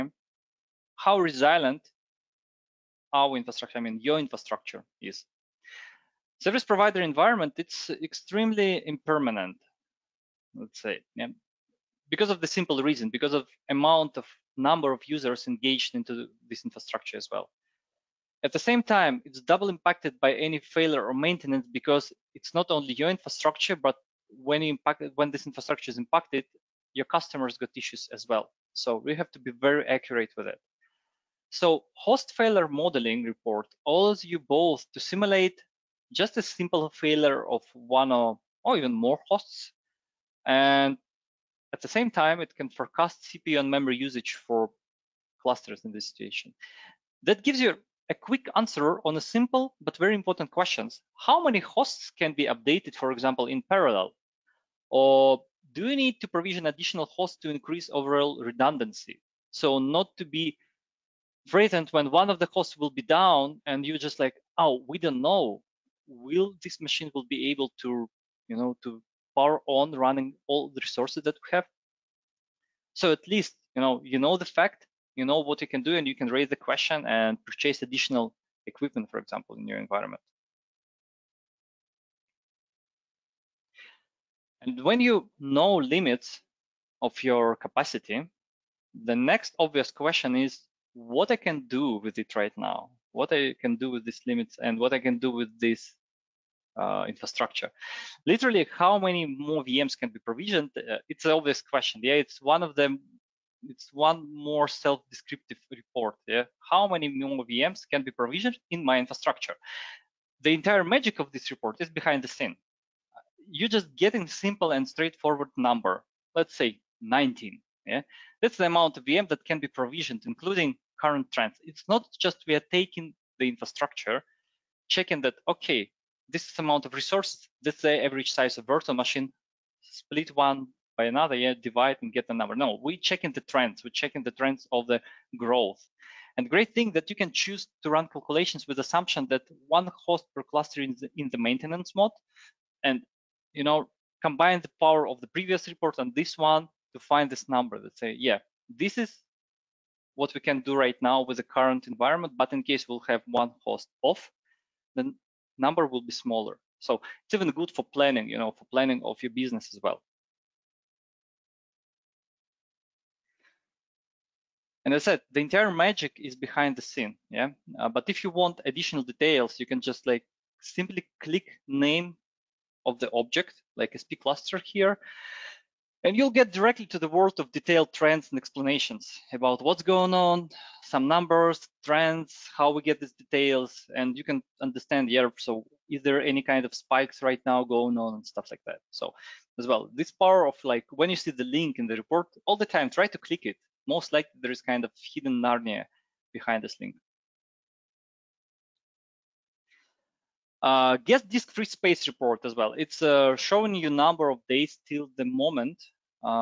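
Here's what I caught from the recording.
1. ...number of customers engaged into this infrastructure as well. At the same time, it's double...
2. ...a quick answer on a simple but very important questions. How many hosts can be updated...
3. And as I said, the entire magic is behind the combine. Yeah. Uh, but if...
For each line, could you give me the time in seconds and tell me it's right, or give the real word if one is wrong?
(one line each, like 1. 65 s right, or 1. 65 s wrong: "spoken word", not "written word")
1. 14 s wrong: "users", not "customers"
2. 48 s right
3. 164 s wrong: "scene", not "combine".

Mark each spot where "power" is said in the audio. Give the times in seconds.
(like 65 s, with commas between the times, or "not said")
69 s, 144 s, 190 s.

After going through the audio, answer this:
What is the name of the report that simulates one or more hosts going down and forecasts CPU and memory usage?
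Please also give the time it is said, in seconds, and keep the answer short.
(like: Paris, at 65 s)
Host failure modeling report, at 31 s.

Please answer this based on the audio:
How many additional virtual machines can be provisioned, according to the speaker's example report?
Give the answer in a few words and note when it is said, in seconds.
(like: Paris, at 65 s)
19, at 117 s.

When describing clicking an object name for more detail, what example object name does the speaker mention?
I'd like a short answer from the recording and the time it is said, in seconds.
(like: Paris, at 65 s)
SP cluster, at 173 s.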